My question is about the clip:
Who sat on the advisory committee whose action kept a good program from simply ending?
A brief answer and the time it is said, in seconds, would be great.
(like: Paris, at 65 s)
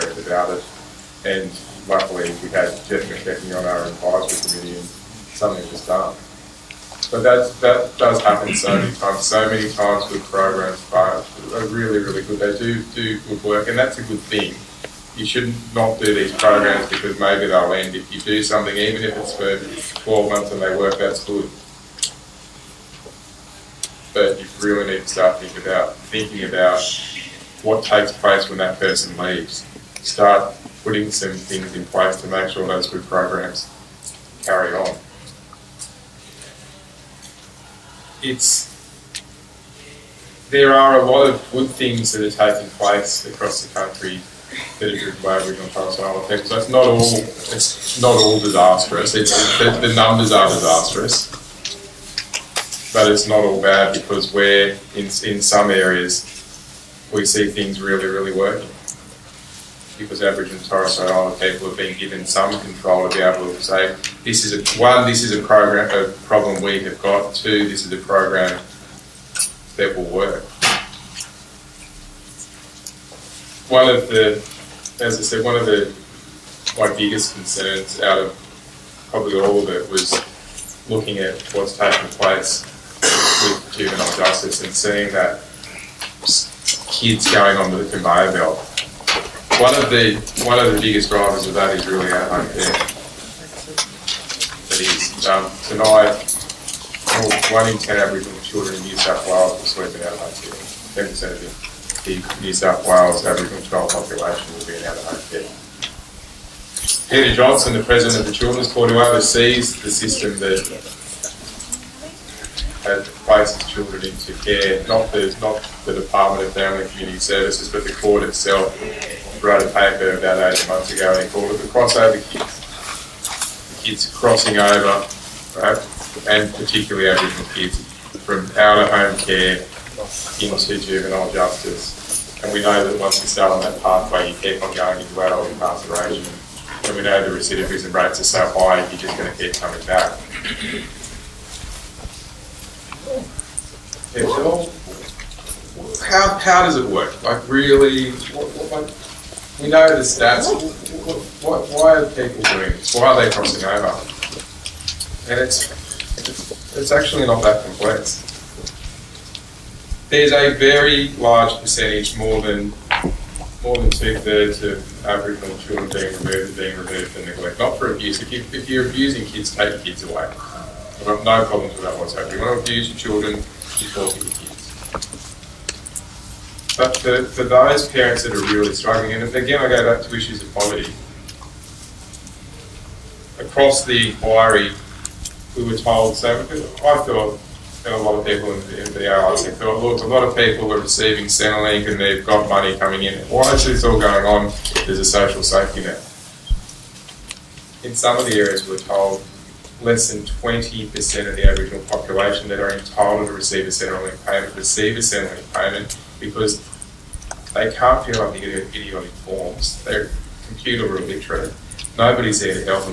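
Jeff McKechnie, at 2 s.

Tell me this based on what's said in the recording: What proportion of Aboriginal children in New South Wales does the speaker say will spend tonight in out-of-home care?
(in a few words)
1 in 10.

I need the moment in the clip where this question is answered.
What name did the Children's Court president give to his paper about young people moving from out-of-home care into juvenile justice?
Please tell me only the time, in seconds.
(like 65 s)
121 s.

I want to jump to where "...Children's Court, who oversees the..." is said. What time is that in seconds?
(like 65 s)
108 s.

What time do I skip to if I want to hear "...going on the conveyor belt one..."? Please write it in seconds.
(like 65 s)
87 s.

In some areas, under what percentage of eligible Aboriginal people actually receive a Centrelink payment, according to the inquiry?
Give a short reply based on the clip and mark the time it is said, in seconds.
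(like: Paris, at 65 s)
20%, at 200 s.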